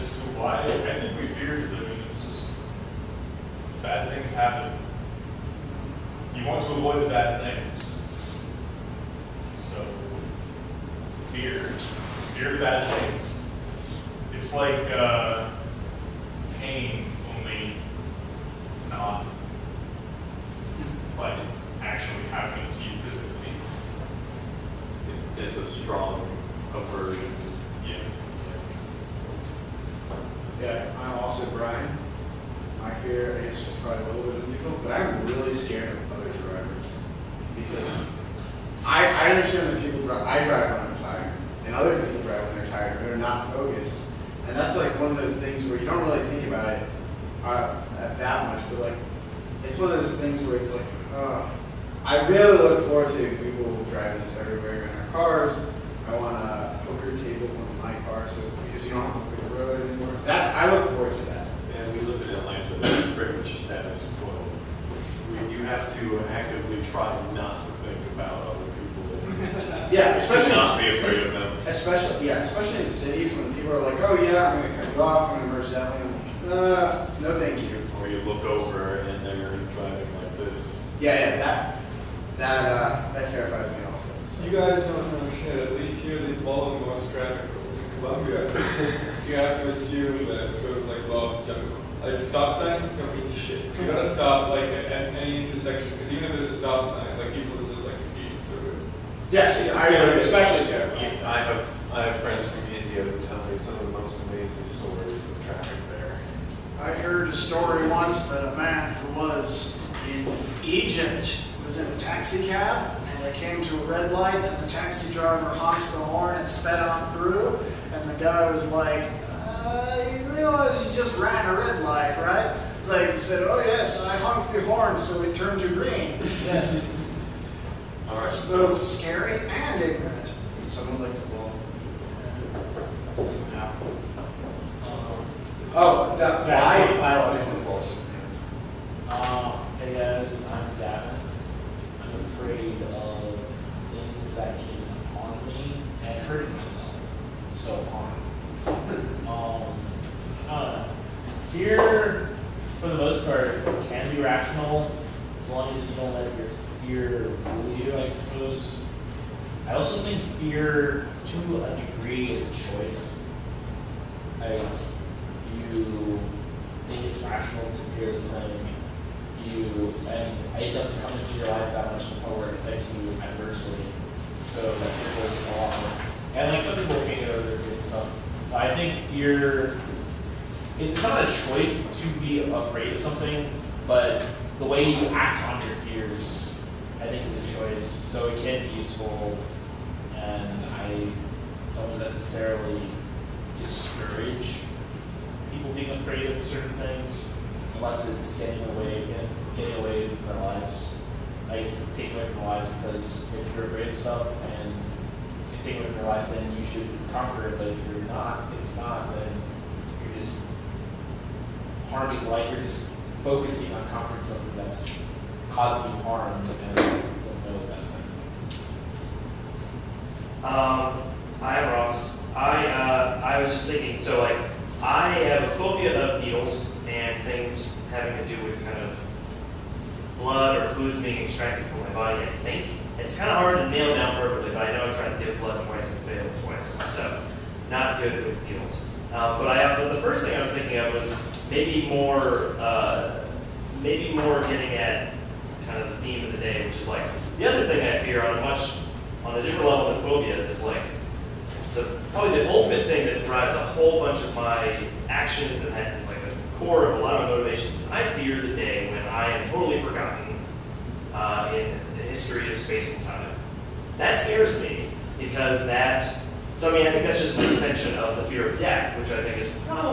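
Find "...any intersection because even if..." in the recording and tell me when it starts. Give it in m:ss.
1:34.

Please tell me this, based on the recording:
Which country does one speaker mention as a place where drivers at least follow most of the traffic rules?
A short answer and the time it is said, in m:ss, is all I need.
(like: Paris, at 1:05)
Colombia, at 1:27.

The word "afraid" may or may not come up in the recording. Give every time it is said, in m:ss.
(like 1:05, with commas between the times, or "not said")
1:10, 2:22, 3:02, 3:15, 3:23.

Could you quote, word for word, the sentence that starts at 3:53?
It's kind of hard to nail down perfectly, but I know I tried to give blood twice and failed twice.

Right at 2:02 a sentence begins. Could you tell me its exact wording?
It's like you said, oh yes, I honked the horn so it turned to green.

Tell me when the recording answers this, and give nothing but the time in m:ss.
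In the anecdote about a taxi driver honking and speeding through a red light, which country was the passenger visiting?
1:50.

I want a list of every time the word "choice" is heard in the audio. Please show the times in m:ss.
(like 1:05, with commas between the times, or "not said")
2:42, 3:01, 3:07.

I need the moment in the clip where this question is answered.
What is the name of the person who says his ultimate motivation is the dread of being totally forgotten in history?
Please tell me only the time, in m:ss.
3:41.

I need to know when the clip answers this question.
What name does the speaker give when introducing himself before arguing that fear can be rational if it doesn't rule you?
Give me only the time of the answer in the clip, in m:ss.
2:20.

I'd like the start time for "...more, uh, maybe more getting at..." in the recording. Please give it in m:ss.
4:01.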